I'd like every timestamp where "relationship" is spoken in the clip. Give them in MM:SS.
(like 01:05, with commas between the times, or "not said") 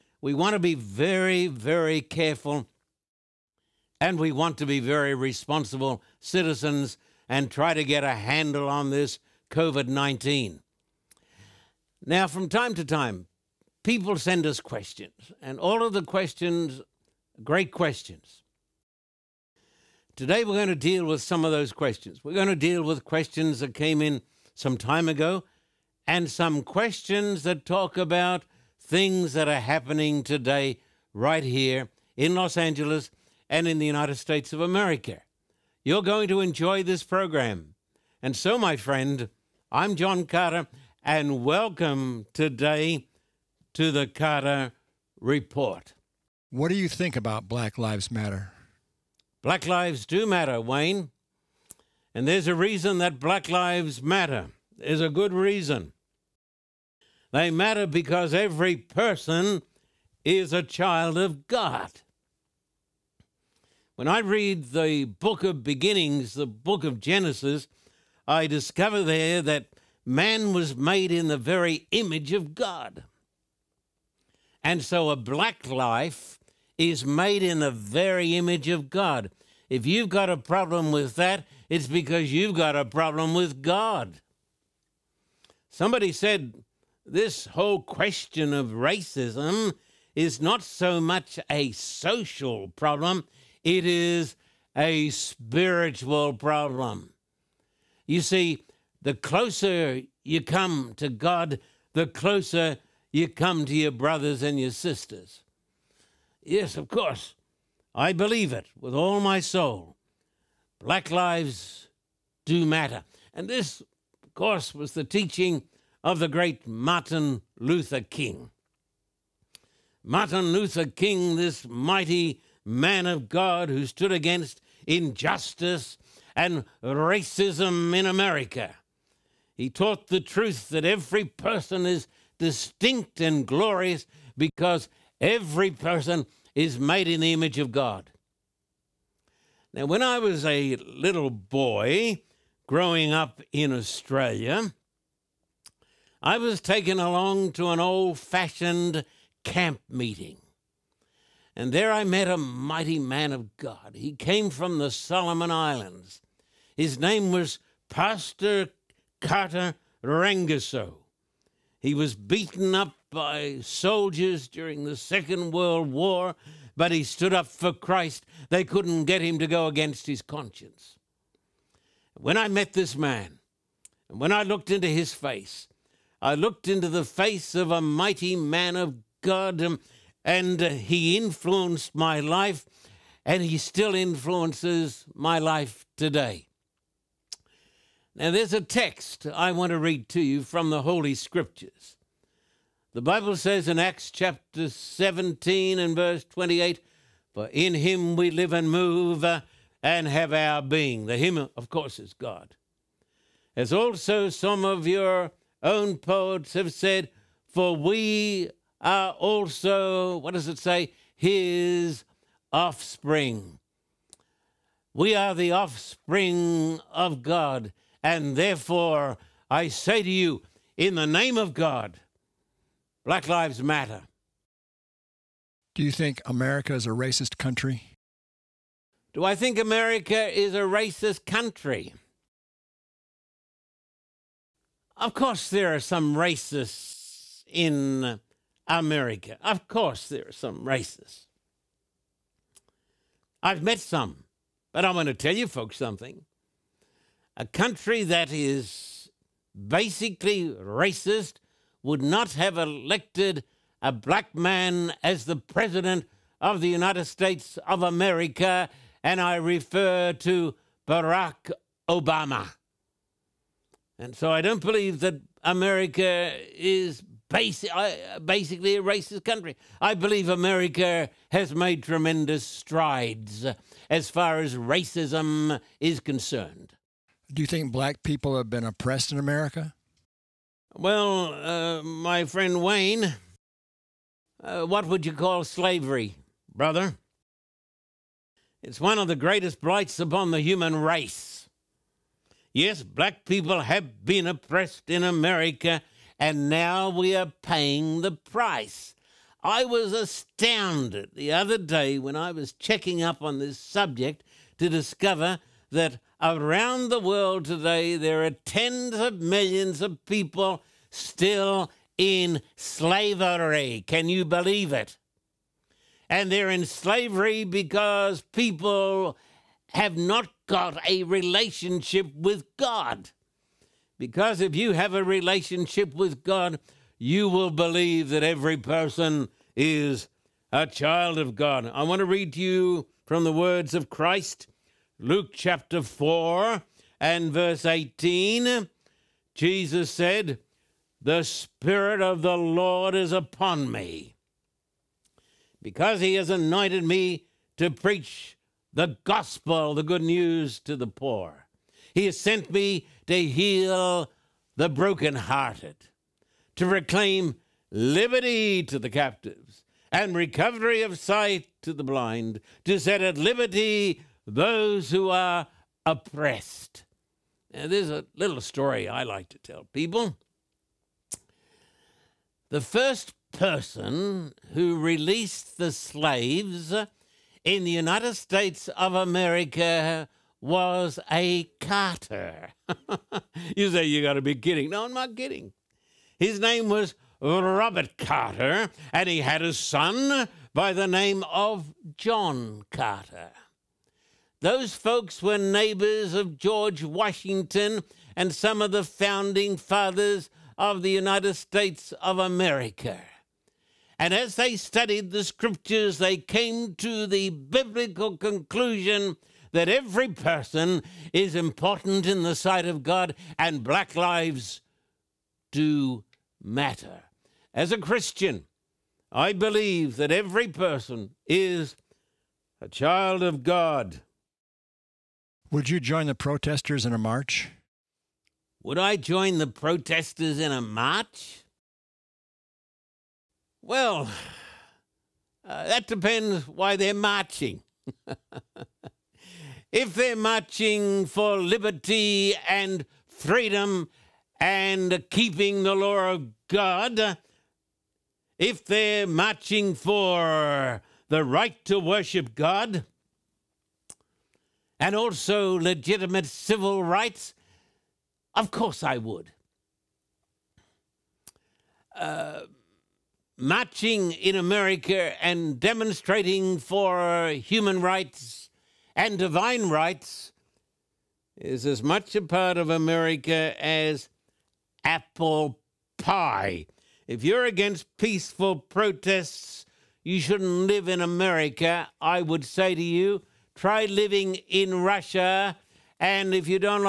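05:21, 05:25.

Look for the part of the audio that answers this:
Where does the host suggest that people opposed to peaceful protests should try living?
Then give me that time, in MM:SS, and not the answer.
08:04.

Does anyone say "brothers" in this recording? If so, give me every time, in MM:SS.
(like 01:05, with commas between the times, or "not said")
01:43, 04:46.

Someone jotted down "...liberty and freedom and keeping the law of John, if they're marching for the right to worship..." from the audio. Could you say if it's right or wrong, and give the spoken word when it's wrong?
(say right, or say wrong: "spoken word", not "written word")
wrong: "God", not "John".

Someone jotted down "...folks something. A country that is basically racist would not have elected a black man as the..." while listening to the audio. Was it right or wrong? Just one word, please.
right.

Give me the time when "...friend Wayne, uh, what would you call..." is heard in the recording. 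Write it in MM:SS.
04:42.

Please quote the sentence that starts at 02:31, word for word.
And there I met a mighty man of God.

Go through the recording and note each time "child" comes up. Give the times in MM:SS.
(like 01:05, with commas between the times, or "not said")
01:00, 05:30, 07:02.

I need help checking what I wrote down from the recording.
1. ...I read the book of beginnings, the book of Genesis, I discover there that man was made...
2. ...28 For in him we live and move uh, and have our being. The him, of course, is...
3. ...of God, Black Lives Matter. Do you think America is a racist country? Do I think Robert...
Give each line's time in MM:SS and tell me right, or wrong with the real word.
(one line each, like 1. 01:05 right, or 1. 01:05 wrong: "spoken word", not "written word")
1. 01:04 right
2. 03:16 right
3. 03:41 wrong: "America", not "Robert".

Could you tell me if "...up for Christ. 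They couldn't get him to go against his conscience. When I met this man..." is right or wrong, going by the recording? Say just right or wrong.
right.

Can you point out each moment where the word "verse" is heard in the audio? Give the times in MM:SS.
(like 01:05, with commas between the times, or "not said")
03:15, 05:37.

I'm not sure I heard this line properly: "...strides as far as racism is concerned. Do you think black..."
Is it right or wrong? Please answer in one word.
right.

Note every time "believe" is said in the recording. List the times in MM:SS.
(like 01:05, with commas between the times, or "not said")
01:48, 04:24, 04:29, 05:14, 05:27, 06:59.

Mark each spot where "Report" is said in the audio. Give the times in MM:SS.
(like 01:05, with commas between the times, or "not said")
00:45.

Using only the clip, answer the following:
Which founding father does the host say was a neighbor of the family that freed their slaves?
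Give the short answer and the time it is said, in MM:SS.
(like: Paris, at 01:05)
George Washington, at 06:36.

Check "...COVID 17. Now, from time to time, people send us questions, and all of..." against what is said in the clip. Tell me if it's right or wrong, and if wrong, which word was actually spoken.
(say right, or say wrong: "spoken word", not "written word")
wrong: "19", not "17".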